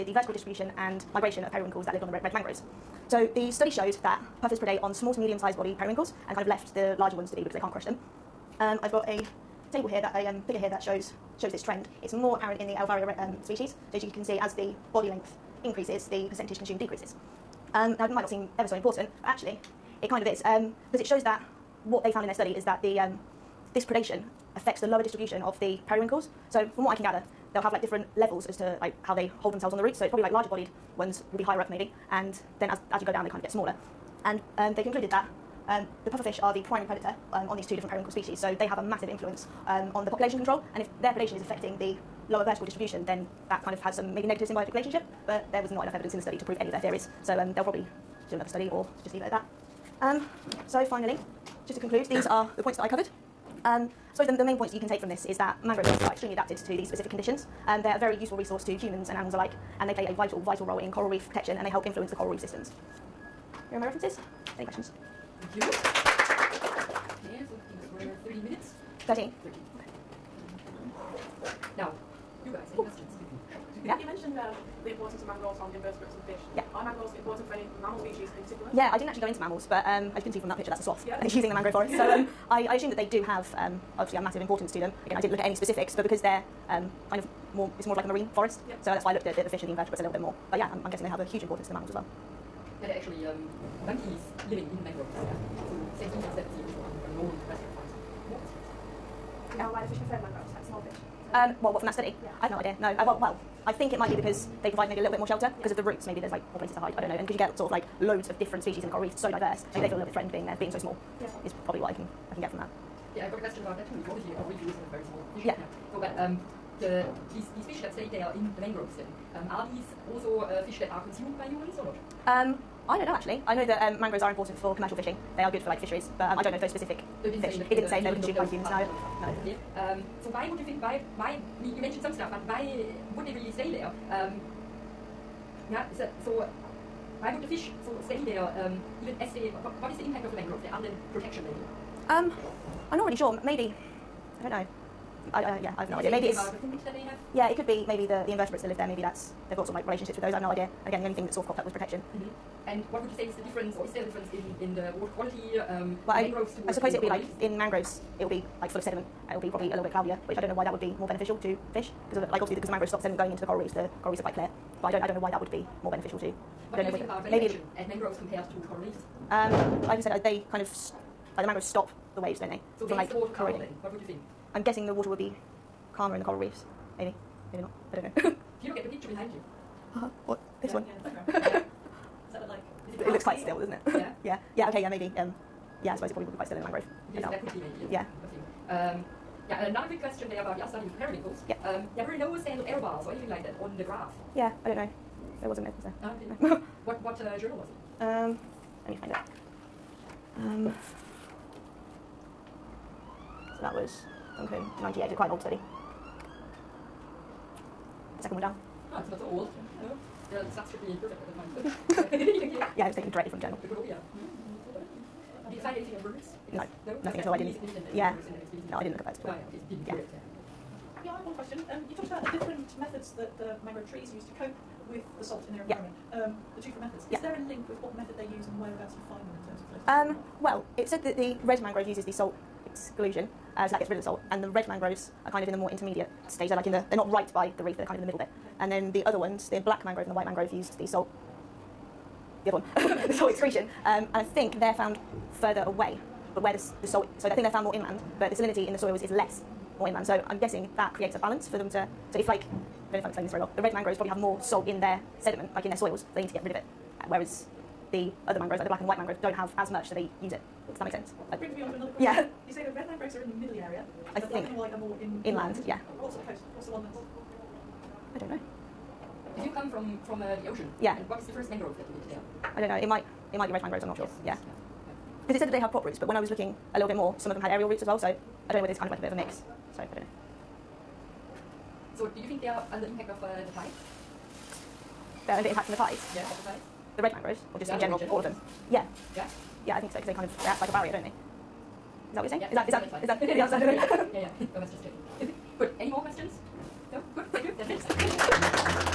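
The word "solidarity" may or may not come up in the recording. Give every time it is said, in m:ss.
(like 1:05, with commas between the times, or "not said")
not said.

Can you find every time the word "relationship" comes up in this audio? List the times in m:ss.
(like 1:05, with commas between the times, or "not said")
0:44, 2:29.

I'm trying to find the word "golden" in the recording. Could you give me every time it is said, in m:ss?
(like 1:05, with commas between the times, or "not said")
not said.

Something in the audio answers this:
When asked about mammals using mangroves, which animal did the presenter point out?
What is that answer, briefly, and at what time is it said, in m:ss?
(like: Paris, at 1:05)
sloth, at 1:20.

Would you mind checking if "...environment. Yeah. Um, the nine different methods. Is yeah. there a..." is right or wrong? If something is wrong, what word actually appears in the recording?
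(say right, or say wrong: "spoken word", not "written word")
wrong: "two", not "nine".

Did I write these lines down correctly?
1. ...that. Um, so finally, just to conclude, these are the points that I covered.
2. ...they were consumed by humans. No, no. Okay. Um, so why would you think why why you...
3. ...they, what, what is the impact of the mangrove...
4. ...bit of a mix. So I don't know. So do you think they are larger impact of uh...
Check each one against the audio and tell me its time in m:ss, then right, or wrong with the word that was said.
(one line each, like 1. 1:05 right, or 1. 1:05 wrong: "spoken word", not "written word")
1. 0:49 right
2. 2:08 right
3. 2:19 right
4. 4:39 wrong: "under", not "larger".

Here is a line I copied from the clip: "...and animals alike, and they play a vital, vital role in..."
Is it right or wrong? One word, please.
right.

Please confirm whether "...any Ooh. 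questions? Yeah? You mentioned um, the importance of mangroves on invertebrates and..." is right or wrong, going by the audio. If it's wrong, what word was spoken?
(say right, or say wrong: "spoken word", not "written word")
right.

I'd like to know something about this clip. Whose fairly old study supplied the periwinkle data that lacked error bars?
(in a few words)
Duncan.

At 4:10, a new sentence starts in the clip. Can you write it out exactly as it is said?
So I'm guessing that creates a balance for them to, so if like I don't know if I'm explaining this very well.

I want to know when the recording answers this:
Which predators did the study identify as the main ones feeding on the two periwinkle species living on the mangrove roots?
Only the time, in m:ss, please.
0:36.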